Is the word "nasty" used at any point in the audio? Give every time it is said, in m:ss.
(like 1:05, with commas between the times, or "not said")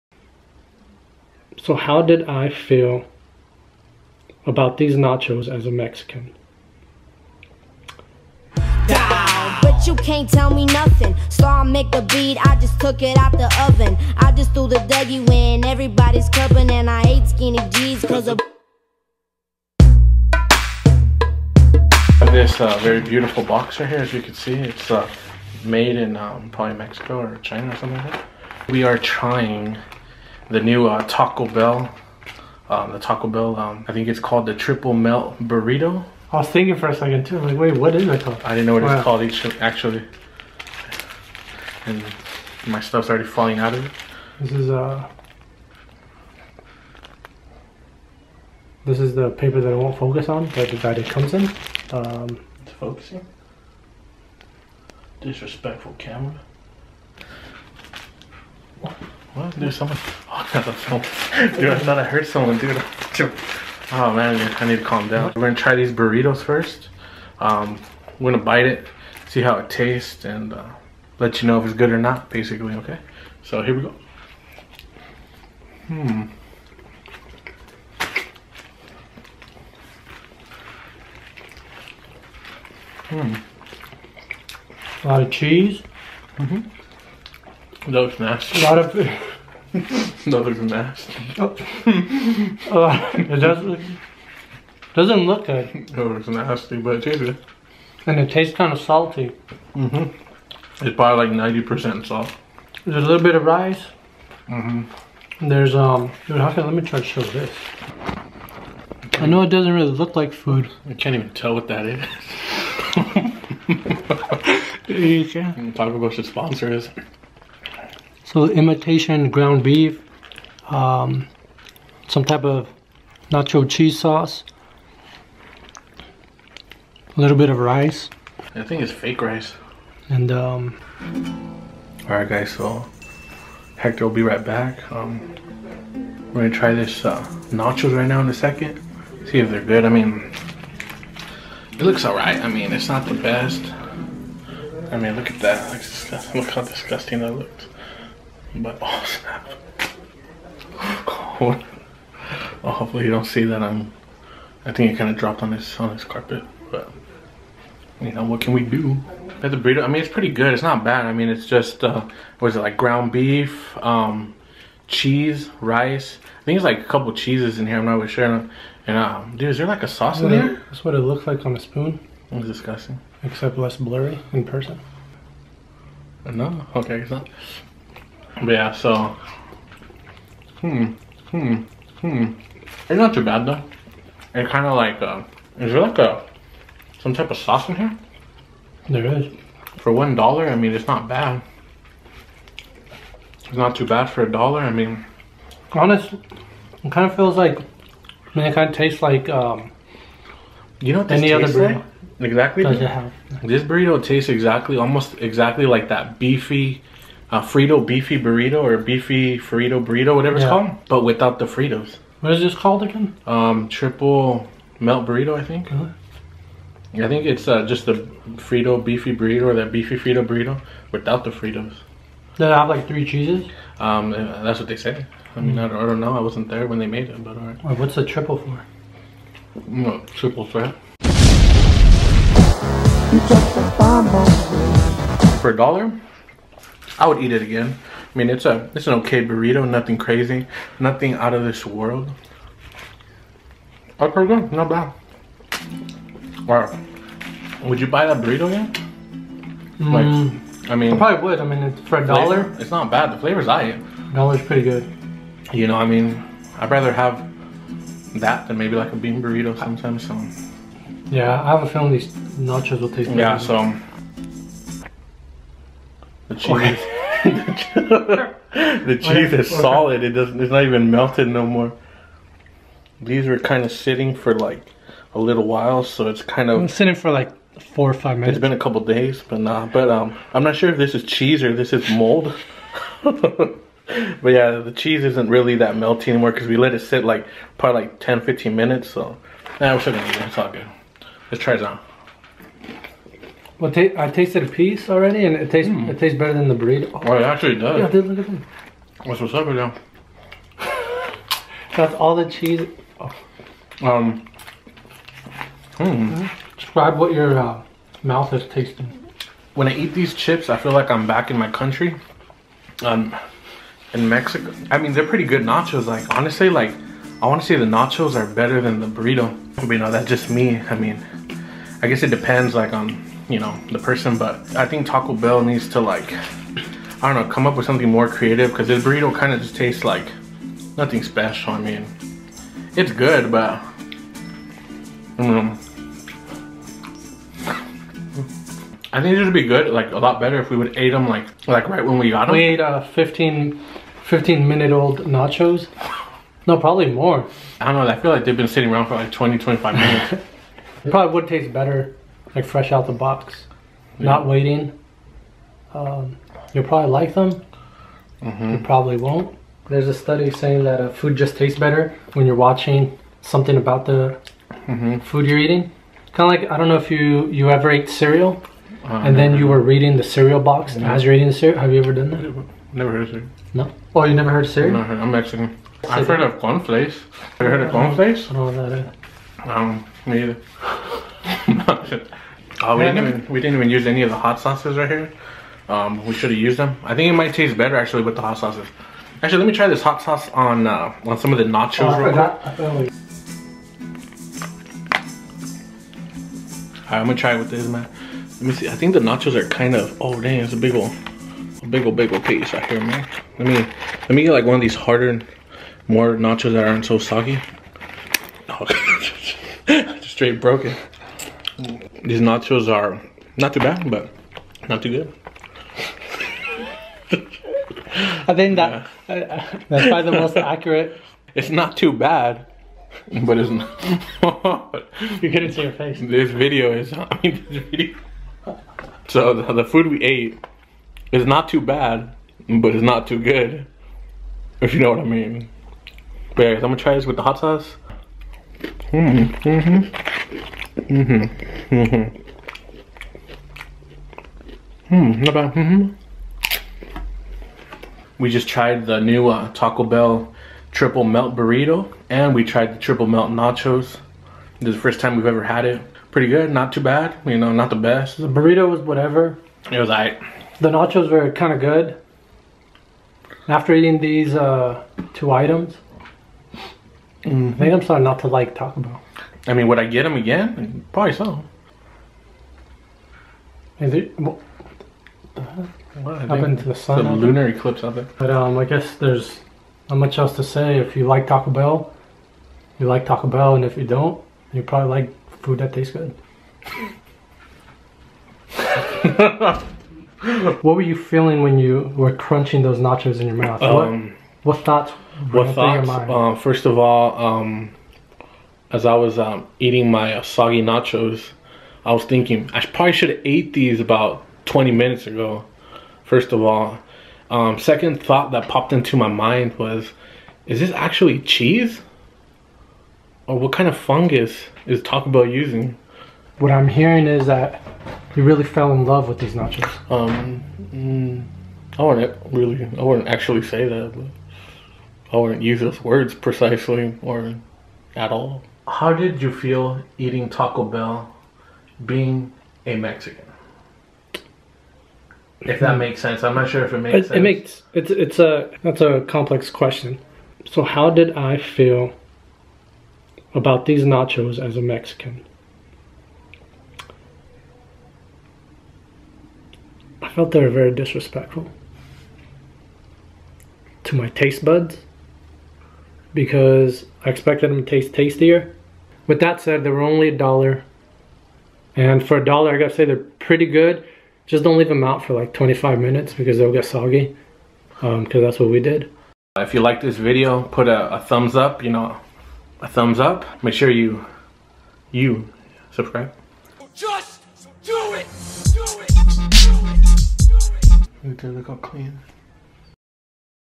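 1:28, 1:36.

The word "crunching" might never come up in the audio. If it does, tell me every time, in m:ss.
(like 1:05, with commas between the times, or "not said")
8:12.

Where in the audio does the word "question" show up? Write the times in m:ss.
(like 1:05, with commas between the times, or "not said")
8:59.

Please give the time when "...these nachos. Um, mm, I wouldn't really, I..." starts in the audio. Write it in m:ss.
8:39.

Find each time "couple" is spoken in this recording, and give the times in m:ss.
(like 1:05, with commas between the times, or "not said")
2:46, 4:38.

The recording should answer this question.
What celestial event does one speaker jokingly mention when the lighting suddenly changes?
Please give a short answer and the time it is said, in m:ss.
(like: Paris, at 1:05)
lunar eclipse, at 7:57.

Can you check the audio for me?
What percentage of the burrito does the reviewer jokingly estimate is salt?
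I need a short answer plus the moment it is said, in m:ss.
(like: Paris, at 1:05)
90%, at 1:41.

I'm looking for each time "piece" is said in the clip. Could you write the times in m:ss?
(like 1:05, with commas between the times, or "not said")
4:54, 6:42.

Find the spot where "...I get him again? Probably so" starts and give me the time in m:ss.
7:49.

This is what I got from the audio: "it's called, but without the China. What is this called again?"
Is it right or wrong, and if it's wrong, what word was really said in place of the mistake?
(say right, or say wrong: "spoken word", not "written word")
wrong: "Fritos", not "China".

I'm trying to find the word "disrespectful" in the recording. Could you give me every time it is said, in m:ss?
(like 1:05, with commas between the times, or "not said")
0:55, 9:10.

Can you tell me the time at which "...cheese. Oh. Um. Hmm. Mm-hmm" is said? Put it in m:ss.
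5:02.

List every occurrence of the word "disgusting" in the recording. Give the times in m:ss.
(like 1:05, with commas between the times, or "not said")
2:26, 2:52.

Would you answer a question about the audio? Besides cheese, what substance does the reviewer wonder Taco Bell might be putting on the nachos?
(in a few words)
fungus.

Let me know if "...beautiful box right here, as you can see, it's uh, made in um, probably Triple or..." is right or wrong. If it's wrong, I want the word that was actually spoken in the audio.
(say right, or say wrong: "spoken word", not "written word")
wrong: "Mexico", not "Triple".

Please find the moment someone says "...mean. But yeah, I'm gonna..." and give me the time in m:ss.
7:15.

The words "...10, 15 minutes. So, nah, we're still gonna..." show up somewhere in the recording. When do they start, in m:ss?
4:47.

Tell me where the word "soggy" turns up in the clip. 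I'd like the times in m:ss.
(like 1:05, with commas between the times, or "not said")
6:46, 8:20, 9:26.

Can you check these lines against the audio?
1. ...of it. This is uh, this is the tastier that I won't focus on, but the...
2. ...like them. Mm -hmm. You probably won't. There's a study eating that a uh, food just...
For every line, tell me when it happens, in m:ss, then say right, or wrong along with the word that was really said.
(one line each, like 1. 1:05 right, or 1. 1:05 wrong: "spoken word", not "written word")
1. 0:43 wrong: "paper", not "tastier"
2. 5:56 wrong: "saying", not "eating".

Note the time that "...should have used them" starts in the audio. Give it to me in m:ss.
6:26.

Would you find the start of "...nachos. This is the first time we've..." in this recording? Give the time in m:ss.
7:33.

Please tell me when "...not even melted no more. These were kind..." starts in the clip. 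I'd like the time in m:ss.
4:30.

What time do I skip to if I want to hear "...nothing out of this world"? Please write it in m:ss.
4:00.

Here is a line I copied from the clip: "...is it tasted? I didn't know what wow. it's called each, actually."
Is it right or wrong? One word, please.
wrong.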